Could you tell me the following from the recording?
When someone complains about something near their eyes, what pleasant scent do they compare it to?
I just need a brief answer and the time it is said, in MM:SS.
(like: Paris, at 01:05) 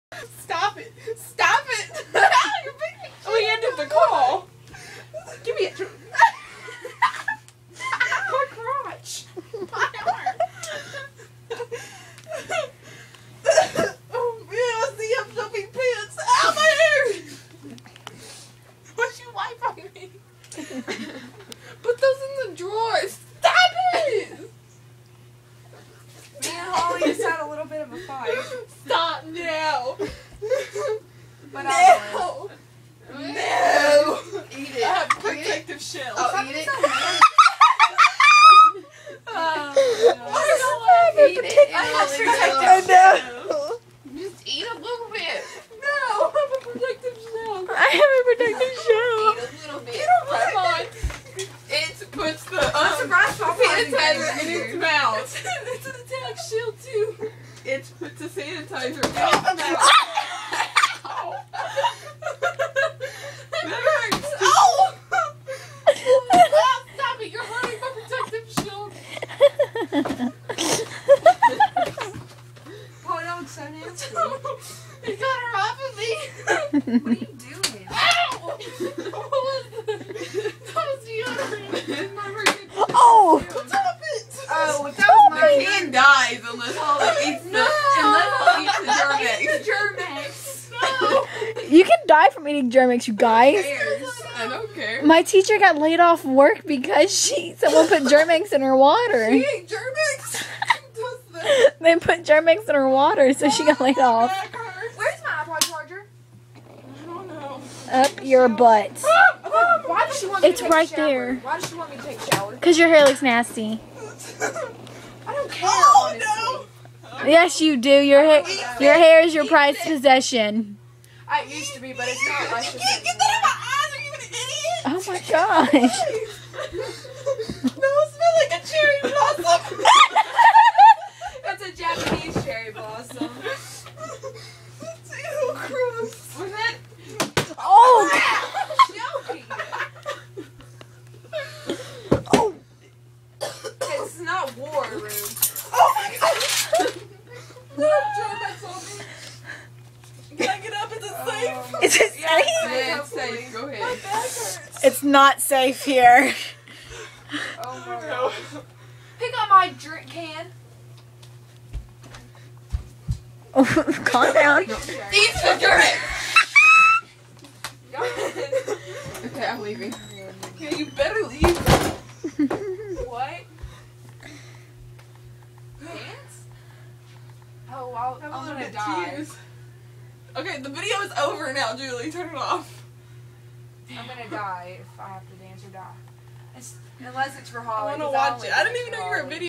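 cherry blossom, at 02:08.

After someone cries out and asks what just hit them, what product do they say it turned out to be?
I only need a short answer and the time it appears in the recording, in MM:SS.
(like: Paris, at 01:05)
deodorant, at 01:21.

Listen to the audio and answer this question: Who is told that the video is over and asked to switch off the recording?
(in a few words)
Julie.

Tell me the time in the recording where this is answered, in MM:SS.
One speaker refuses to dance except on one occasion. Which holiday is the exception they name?
03:07.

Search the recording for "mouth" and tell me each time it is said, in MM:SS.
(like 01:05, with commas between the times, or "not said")
00:54, 00:59.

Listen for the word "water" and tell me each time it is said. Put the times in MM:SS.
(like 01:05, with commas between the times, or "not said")
01:38, 01:42.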